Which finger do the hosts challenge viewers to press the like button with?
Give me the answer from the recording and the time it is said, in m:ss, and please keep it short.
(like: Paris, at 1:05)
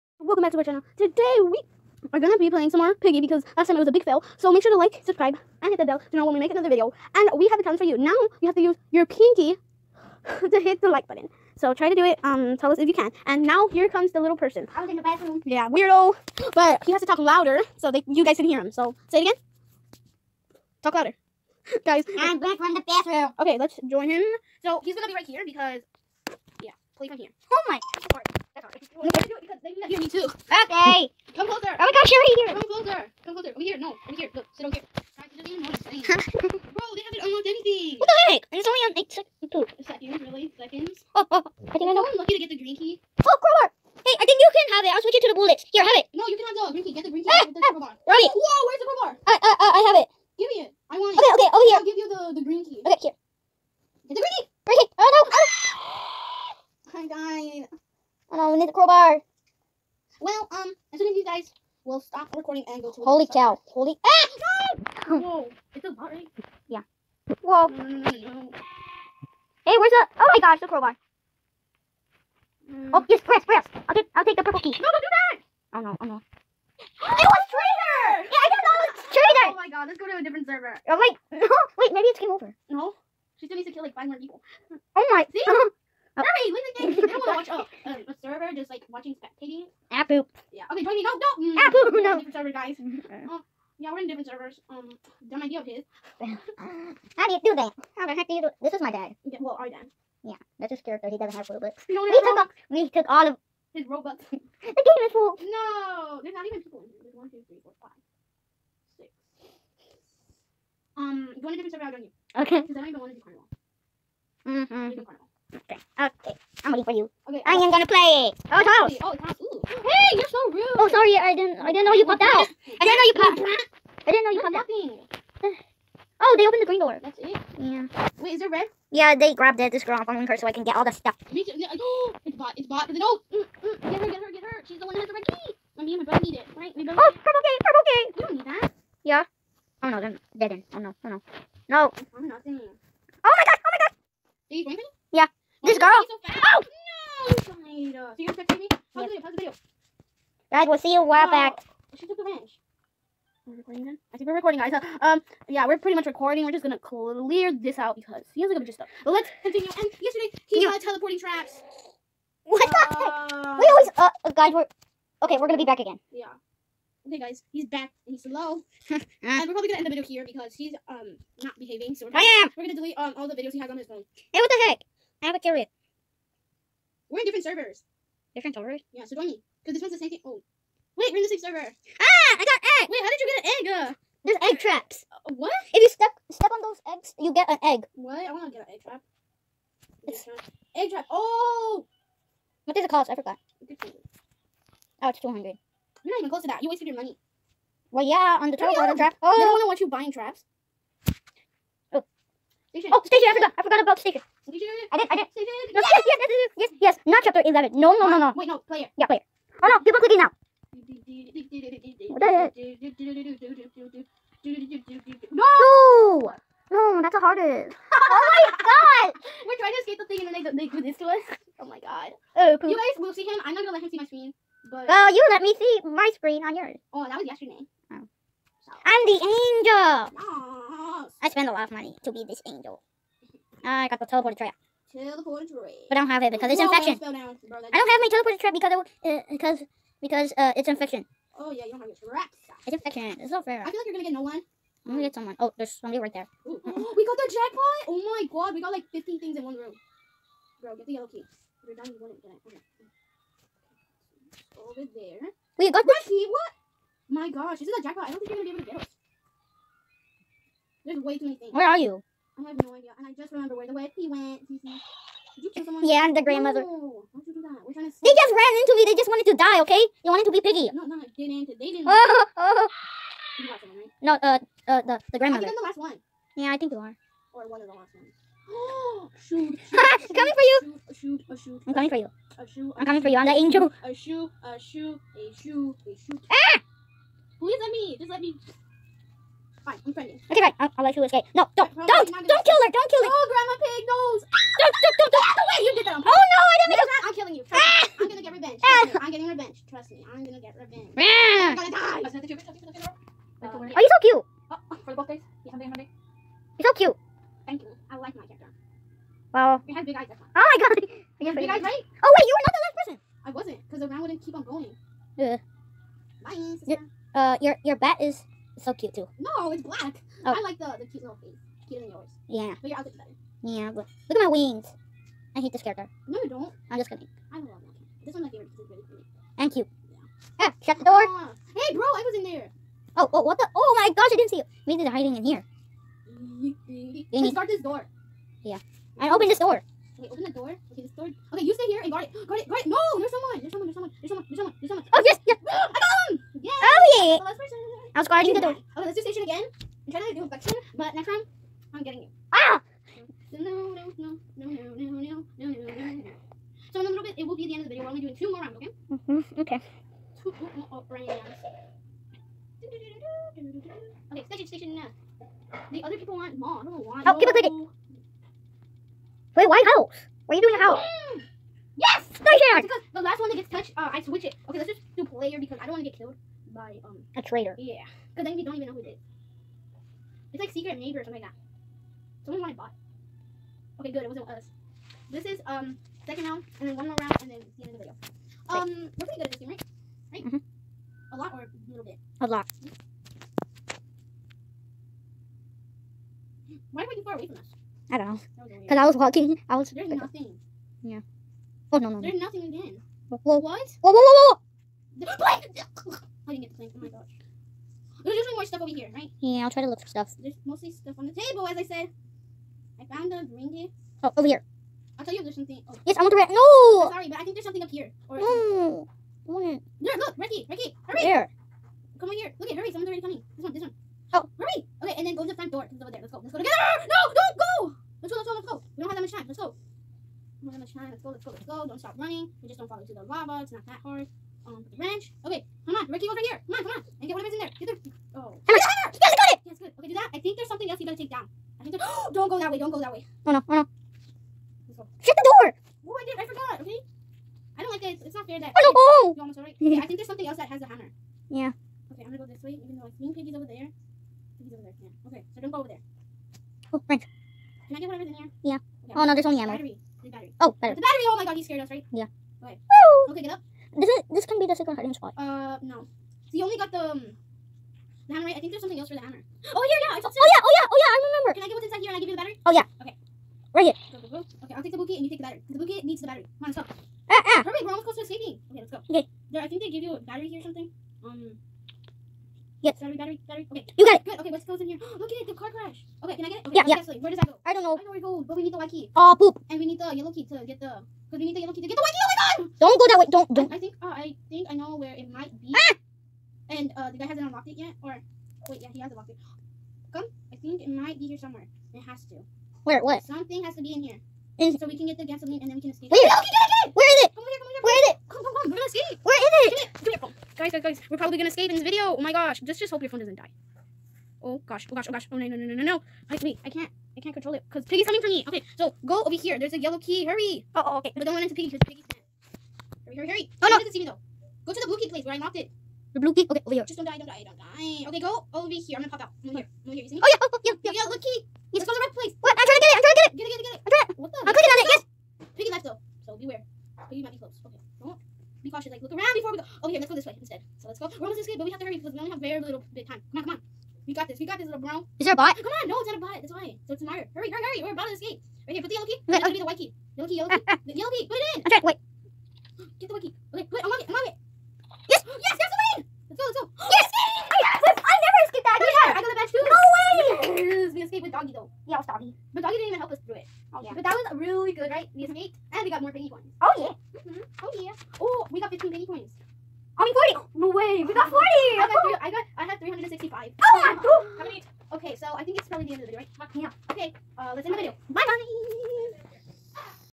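pinky, at 0:09.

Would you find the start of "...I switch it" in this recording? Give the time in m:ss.
6:13.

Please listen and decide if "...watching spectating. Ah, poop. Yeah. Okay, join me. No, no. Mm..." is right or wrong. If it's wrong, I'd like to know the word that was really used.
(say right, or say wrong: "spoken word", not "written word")
right.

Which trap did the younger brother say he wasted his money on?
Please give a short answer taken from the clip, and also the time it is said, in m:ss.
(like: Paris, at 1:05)
turtle water trap, at 3:18.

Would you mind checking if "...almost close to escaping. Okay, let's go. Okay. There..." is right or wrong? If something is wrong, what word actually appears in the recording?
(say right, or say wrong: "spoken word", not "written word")
right.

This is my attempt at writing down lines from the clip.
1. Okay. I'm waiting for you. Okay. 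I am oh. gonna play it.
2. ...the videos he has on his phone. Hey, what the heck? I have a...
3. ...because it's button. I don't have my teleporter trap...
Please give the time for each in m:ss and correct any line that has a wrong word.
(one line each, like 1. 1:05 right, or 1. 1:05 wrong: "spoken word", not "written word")
1. 1:55 right
2. 2:53 right
3. 3:56 wrong: "infection", not "button".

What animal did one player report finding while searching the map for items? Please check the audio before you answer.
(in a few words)
reindeer.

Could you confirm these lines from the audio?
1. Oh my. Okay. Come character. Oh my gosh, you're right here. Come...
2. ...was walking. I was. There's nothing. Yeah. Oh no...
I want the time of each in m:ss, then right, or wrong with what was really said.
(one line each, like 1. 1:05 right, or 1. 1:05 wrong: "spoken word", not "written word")
1. 0:27 wrong: "closer", not "character"
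2. 6:38 right.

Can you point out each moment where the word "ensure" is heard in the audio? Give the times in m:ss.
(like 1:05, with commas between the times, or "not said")
not said.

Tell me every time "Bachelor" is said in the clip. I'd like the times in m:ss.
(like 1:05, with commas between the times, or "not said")
not said.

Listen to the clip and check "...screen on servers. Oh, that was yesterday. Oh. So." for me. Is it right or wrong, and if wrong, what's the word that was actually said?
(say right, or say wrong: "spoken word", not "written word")
wrong: "yours", not "servers".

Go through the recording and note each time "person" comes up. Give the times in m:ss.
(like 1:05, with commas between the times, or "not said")
0:14, 5:12.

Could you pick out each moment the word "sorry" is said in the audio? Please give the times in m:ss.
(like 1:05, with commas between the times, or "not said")
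2:00, 6:56.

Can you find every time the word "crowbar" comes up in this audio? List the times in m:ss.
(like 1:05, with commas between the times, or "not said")
0:58, 1:10.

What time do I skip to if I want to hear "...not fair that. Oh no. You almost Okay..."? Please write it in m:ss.
7:28.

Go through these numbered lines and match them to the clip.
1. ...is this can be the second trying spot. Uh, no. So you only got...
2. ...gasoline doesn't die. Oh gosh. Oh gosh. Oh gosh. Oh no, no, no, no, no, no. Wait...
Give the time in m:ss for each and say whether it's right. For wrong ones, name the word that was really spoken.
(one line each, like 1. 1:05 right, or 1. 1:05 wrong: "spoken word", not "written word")
1. 7:43 wrong: "hiding", not "trying"
2. 8:32 wrong: "phone", not "gasoline".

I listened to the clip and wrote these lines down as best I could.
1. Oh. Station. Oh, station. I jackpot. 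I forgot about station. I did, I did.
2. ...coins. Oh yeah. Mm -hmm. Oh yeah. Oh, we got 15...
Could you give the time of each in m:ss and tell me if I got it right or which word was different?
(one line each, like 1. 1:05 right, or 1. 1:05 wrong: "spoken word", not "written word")
1. 3:21 wrong: "forgot", not "jackpot"
2. 9:26 right.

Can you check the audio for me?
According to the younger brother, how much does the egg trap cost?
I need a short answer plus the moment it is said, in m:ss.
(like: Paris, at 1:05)
200, at 3:15.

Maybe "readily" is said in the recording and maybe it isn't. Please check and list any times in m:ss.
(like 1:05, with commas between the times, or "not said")
not said.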